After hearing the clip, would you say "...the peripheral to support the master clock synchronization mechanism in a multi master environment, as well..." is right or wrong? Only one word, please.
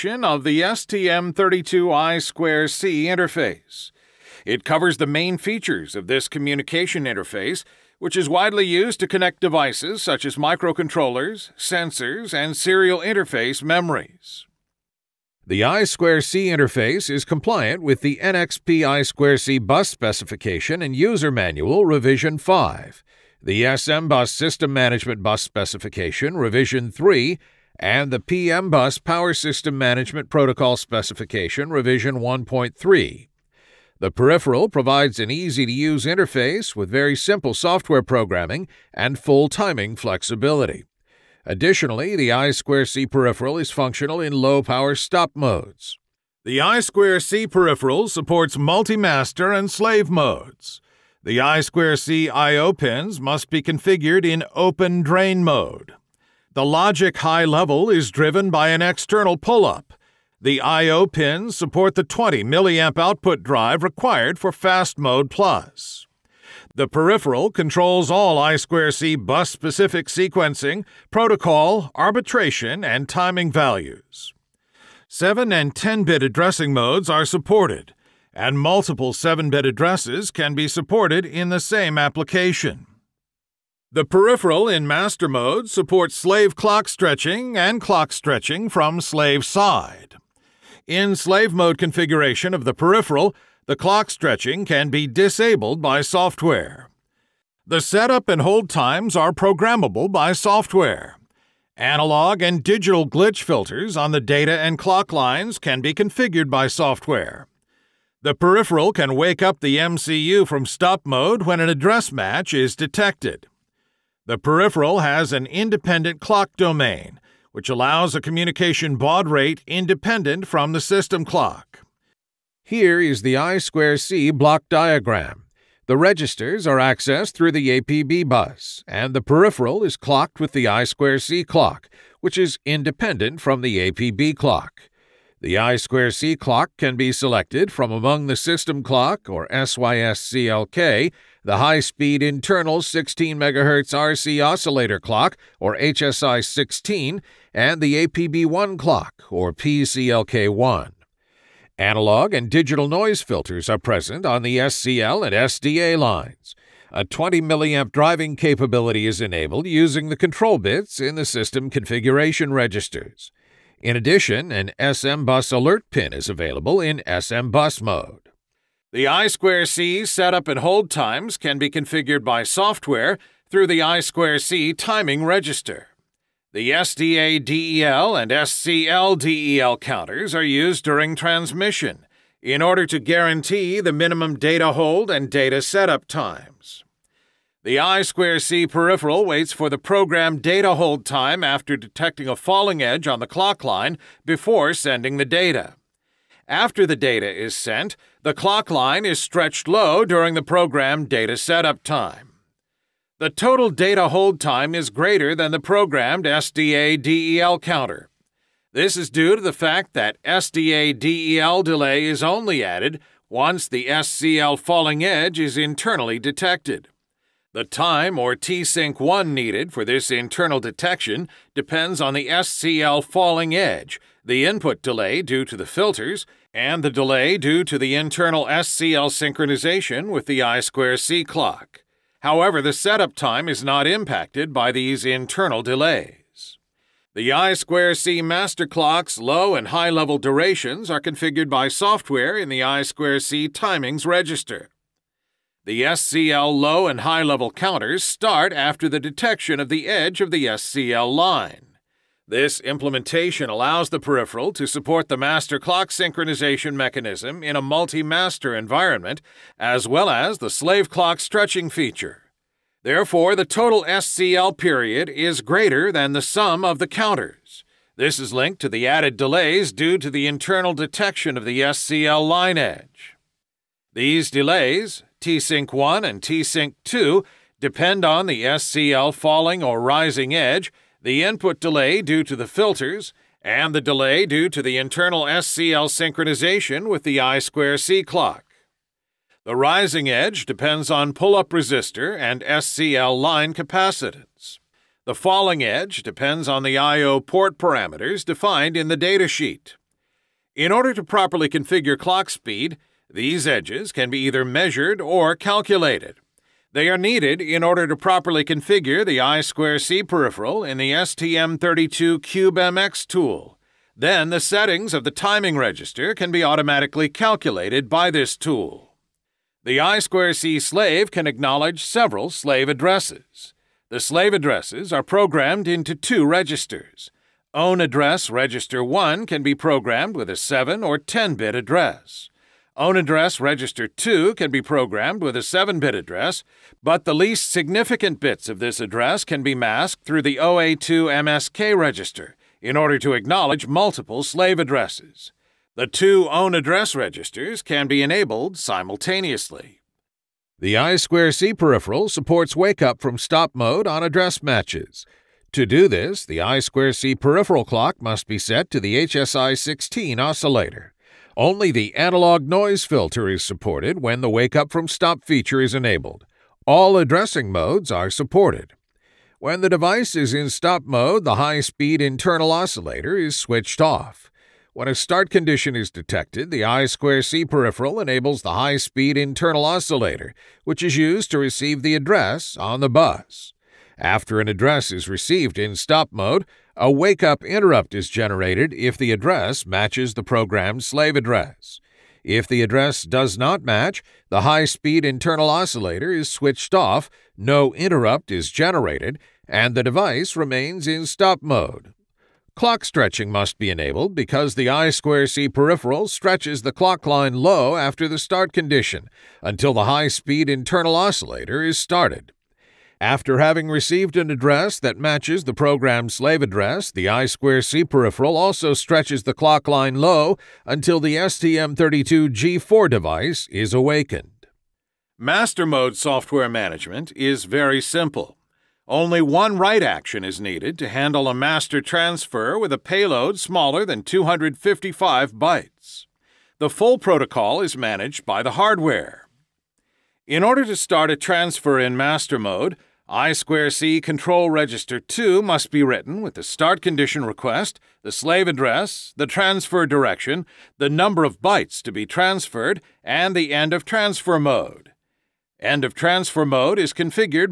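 right.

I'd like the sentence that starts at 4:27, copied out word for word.
This is linked to the added delays due to the internal detection of the SCL line edge.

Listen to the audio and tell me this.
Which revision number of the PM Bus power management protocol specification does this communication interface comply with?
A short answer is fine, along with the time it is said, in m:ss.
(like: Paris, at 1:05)
1.3, at 0:31.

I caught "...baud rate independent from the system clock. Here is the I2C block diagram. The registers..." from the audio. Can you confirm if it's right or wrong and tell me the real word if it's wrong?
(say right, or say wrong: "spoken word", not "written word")
right.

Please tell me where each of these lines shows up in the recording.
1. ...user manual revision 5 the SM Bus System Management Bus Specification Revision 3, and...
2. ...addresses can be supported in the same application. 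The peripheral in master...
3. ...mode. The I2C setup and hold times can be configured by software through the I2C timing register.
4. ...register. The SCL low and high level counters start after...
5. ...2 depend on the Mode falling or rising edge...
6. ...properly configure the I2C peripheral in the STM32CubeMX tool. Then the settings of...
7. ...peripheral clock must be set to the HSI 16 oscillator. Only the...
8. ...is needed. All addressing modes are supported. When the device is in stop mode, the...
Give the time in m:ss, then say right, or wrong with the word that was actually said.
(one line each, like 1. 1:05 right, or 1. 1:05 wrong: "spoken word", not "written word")
1. 0:20 right
2. 1:19 right
3. 2:47 right
4. 4:04 right
5. 4:36 wrong: "SCL", not "Mode"
6. 5:07 right
7. 5:57 right
8. 6:05 wrong: "enabled", not "needed".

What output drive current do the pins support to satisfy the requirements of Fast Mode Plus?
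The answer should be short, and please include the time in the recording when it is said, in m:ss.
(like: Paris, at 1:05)
20 milliamp, at 1:02.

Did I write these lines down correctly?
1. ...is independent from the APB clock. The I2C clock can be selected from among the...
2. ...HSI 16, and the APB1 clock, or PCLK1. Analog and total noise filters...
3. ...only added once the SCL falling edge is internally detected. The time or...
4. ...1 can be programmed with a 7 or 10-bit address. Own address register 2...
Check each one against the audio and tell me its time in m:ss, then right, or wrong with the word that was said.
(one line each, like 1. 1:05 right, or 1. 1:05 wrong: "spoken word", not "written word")
1. 2:12 right
2. 2:25 wrong: "digital", not "total"
3. 3:32 right
4. 5:28 right.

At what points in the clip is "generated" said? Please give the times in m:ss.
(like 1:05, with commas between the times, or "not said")
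6:28, 6:38.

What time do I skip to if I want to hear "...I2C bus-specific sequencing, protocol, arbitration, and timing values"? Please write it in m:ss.
1:08.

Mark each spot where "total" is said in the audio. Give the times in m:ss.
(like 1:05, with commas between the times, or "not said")
3:23, 4:23.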